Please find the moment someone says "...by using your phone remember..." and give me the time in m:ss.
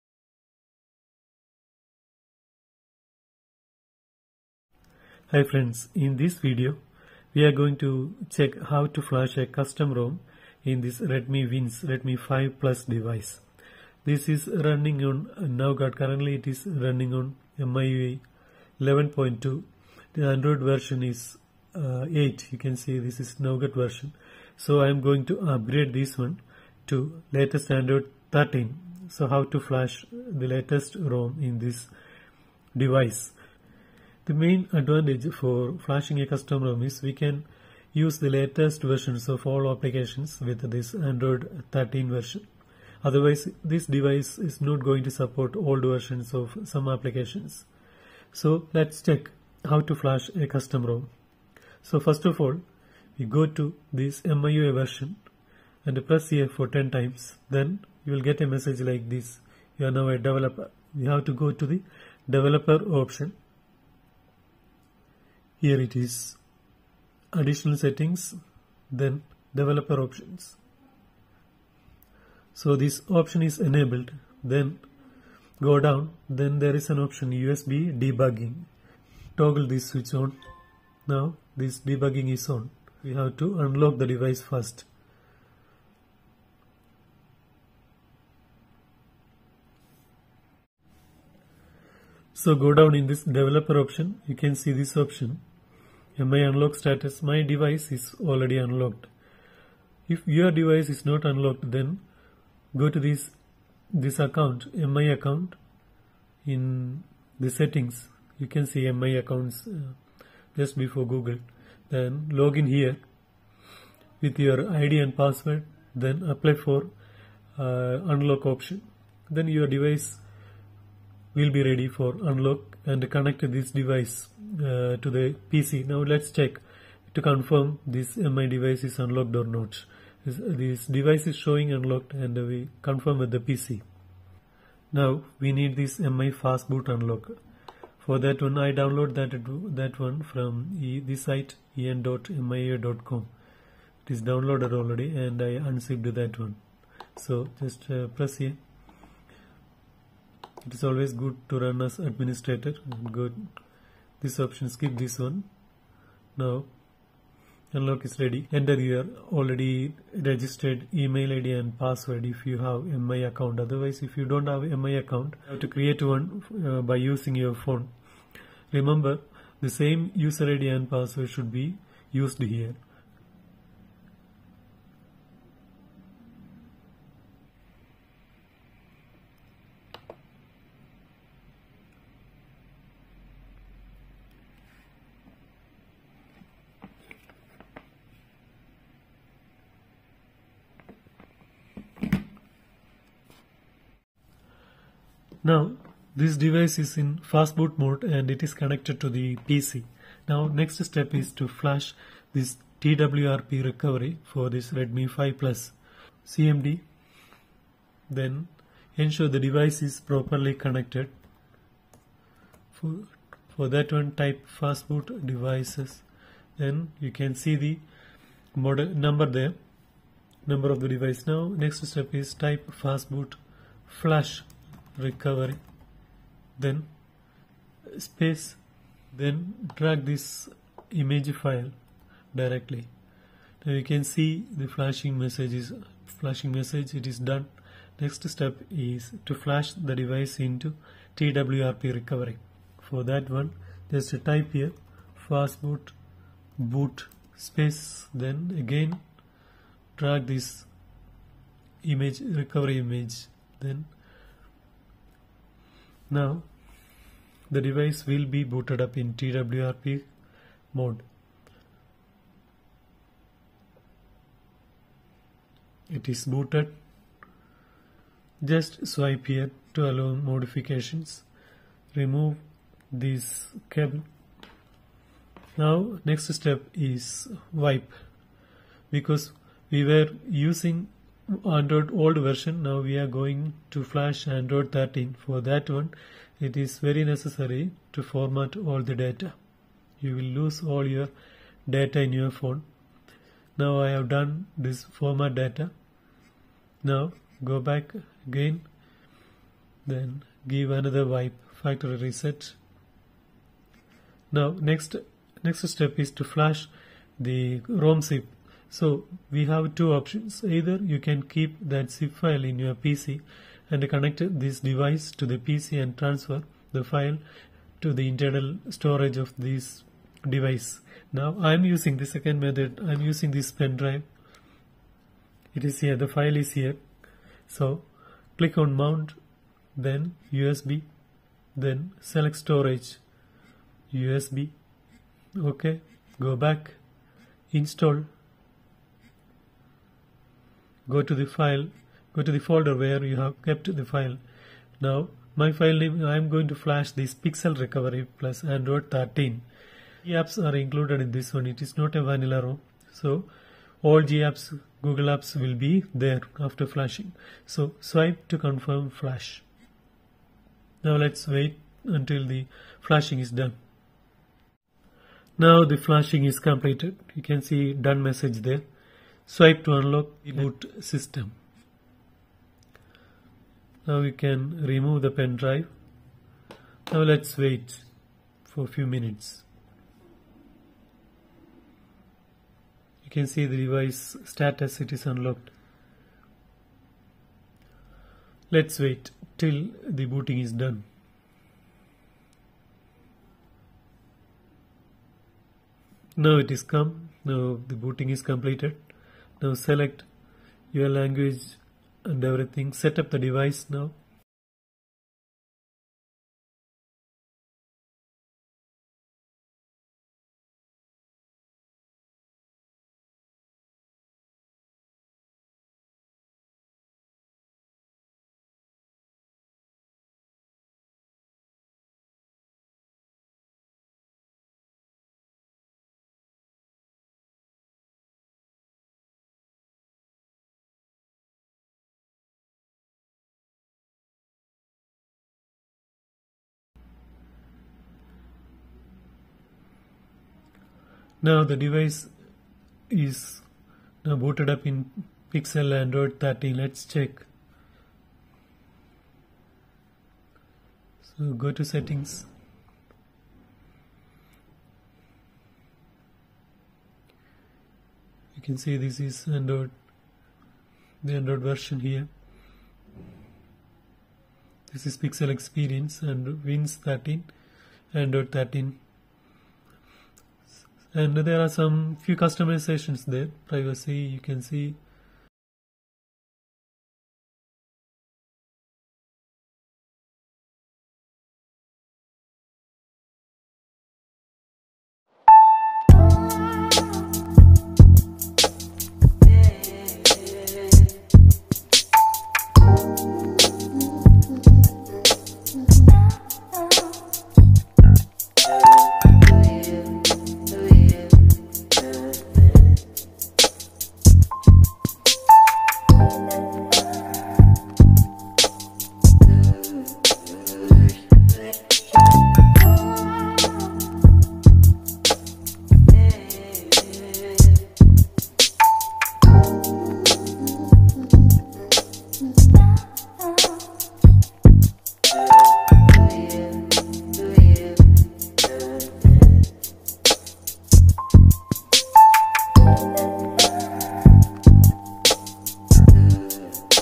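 2:46.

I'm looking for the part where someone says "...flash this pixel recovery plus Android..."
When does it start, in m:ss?
5:46.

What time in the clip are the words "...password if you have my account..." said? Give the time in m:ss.
2:41.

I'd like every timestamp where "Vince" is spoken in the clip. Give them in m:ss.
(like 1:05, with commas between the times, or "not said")
0:11, 7:46.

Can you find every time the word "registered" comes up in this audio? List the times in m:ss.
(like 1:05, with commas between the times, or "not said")
2:40.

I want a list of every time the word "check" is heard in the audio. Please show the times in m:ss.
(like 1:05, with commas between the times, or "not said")
0:08, 0:49, 2:06, 7:26.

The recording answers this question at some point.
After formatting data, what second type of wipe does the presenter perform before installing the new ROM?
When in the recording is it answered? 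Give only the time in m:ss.
5:01.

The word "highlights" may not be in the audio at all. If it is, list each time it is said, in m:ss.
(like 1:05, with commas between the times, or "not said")
not said.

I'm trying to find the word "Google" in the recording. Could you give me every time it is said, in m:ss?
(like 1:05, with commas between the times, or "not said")
1:51, 5:54.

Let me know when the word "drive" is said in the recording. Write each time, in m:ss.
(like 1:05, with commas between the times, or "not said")
5:23, 6:15.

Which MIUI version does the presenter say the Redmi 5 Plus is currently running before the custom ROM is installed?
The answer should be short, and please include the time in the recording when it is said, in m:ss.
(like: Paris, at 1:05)
MIUI 11.2, at 0:17.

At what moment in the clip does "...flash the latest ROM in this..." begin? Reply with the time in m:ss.
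0:29.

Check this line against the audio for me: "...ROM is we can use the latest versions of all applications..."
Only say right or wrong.
right.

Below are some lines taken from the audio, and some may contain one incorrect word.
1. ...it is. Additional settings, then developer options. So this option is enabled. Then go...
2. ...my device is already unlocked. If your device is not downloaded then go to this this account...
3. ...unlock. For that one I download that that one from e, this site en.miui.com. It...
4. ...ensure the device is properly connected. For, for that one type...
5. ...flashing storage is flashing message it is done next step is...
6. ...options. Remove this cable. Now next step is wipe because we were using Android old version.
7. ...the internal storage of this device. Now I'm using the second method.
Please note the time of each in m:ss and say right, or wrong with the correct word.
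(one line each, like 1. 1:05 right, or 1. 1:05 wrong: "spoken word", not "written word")
1. 1:05 right
2. 1:37 wrong: "unlocked", not "downloaded"
3. 2:16 right
4. 3:28 right
5. 3:54 wrong: "message", not "storage"
6. 4:30 wrong: "modifications", not "options"
7. 5:17 right.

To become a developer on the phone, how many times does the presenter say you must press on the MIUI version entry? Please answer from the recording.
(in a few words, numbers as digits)
10.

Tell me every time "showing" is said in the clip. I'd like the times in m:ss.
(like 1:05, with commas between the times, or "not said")
2:11.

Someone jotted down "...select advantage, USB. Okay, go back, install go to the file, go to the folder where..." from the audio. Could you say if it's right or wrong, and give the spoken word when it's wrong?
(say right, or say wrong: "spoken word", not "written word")
wrong: "storage", not "advantage".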